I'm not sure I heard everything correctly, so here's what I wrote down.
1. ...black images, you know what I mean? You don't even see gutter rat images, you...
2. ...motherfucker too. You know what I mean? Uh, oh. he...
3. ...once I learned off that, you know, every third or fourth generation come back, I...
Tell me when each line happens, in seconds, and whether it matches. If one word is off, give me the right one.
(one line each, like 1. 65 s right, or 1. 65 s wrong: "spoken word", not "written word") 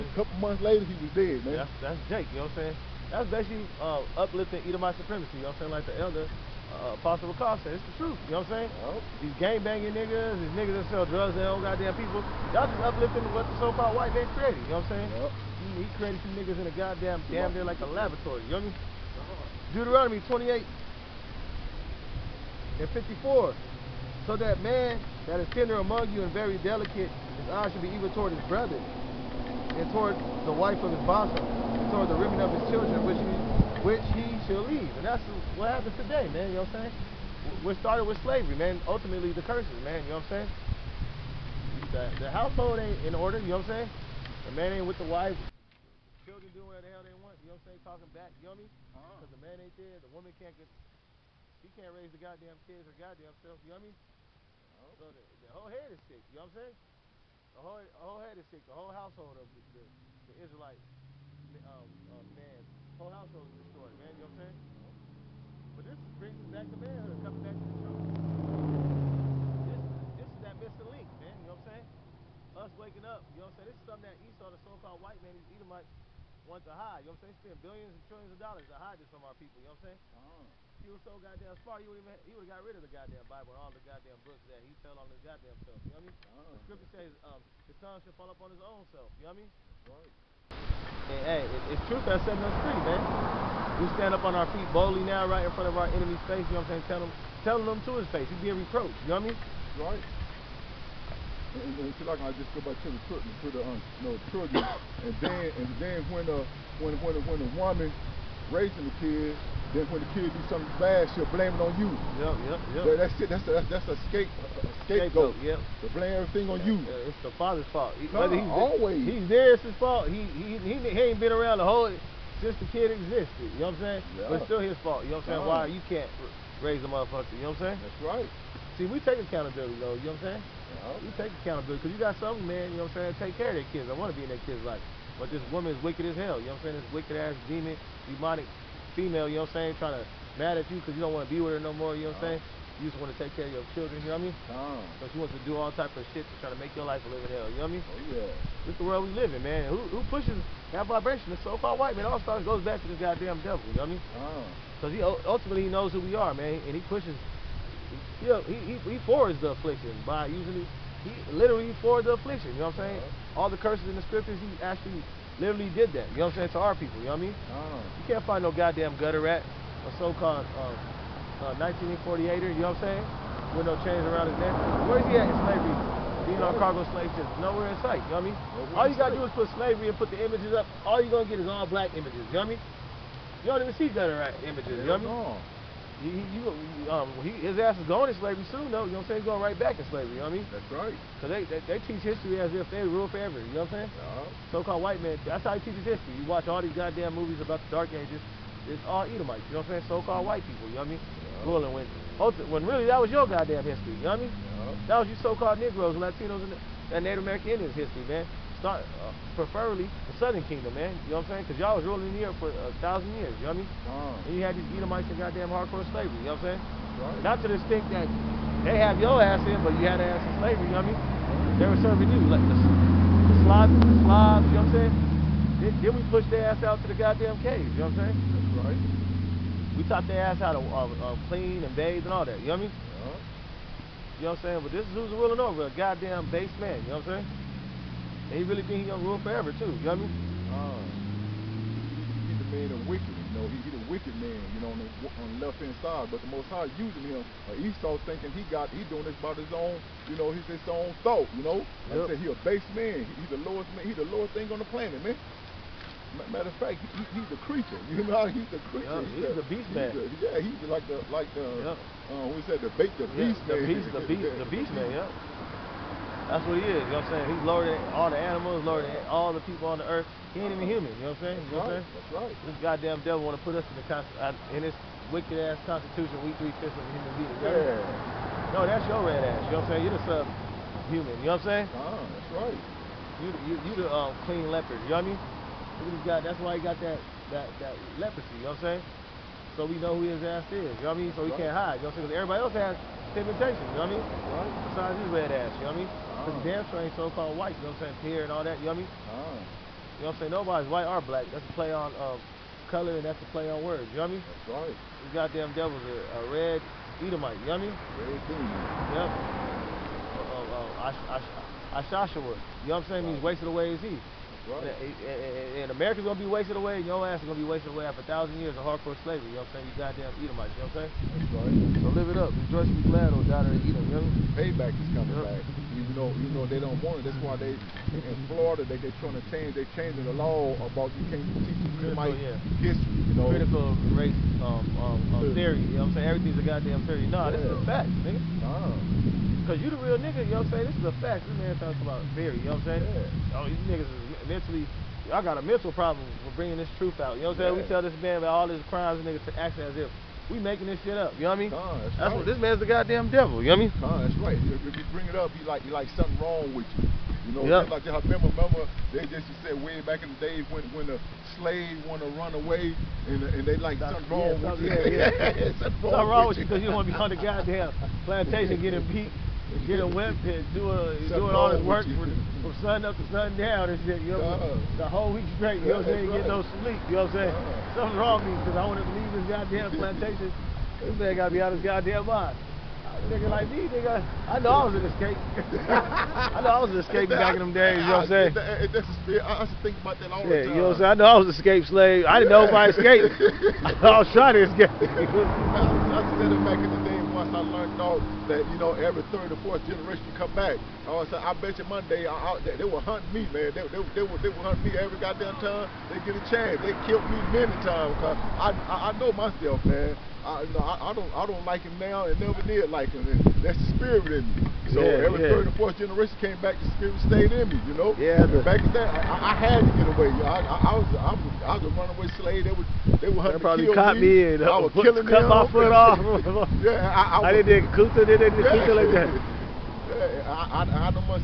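1. 181 s right
2. 239 s wrong: "forever", not "motherfucker"
3. 397 s right.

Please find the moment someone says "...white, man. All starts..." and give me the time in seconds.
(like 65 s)
151 s.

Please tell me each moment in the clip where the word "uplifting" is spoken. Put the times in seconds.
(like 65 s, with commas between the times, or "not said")
4 s, 12 s.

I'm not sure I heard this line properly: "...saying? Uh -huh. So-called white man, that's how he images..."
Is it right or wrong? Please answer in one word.
wrong.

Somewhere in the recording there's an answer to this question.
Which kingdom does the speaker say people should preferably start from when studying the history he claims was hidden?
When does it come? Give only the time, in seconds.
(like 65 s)
210 s.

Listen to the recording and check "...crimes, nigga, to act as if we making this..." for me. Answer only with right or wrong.
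right.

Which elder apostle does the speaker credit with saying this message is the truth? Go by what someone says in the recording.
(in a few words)
Ricard.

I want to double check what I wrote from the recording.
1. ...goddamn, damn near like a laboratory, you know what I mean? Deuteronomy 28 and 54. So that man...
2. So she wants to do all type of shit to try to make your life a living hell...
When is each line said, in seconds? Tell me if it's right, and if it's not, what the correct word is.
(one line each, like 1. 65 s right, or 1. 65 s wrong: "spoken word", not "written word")
1. 16 s right
2. 145 s right.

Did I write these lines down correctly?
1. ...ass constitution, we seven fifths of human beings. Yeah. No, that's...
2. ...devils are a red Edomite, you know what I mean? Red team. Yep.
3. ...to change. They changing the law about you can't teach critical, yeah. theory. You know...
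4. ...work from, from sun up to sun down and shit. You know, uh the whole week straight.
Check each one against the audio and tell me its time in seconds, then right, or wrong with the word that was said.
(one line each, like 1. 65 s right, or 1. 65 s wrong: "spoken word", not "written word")
1. 275 s wrong: "three", not "seven"
2. 305 s right
3. 329 s wrong: "history", not "theory"
4. 371 s right.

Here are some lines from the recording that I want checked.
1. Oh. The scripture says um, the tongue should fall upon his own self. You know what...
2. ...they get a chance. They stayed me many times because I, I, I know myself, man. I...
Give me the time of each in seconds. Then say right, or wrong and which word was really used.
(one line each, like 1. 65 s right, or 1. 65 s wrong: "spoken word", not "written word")
1. 86 s right
2. 405 s wrong: "killed", not "stayed".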